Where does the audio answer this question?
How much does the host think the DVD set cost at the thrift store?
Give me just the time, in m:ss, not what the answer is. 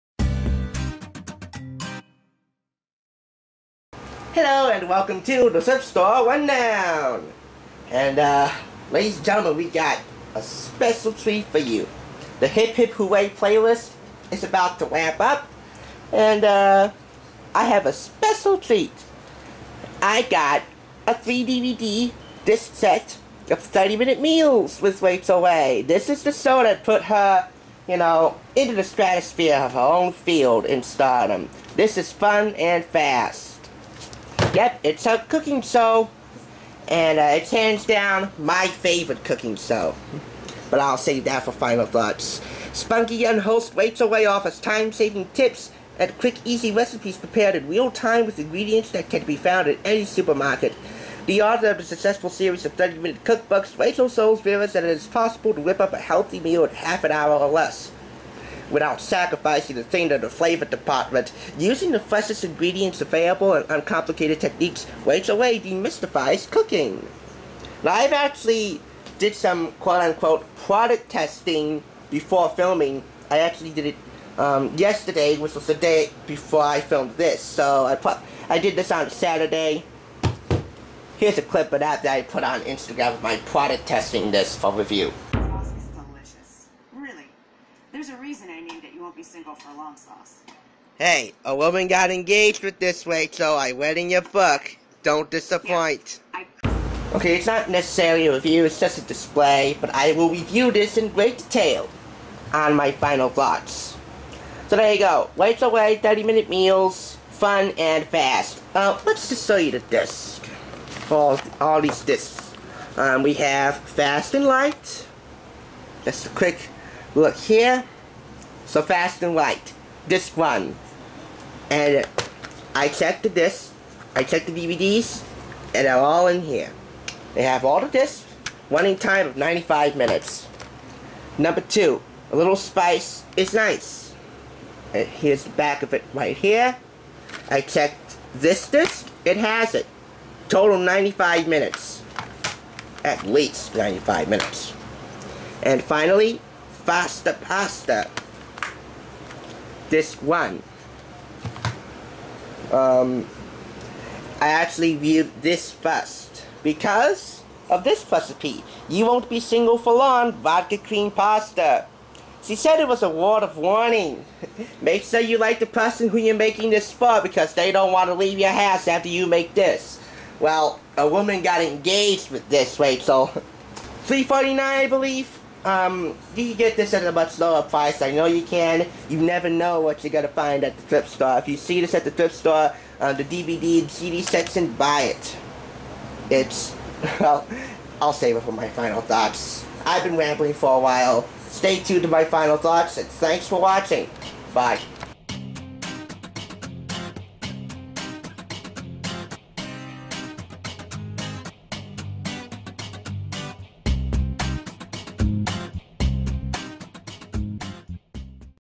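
2:54.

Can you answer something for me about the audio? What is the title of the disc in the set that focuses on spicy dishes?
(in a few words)
A little spice is nice.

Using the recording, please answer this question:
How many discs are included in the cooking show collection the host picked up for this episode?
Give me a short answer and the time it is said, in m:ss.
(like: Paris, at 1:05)
3, at 0:21.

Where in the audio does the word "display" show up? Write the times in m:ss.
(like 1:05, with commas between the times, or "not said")
1:39.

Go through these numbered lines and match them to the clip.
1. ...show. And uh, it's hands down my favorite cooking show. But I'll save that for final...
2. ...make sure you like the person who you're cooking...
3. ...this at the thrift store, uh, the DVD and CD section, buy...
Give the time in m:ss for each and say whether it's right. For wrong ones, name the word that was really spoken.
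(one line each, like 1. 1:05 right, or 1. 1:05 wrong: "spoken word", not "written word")
1. 0:35 right
2. 2:44 wrong: "making", not "cooking"
3. 3:01 right.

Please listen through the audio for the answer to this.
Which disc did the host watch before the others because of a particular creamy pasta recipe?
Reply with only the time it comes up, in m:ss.
2:26.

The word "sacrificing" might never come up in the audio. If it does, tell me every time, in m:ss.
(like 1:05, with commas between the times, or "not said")
0:59.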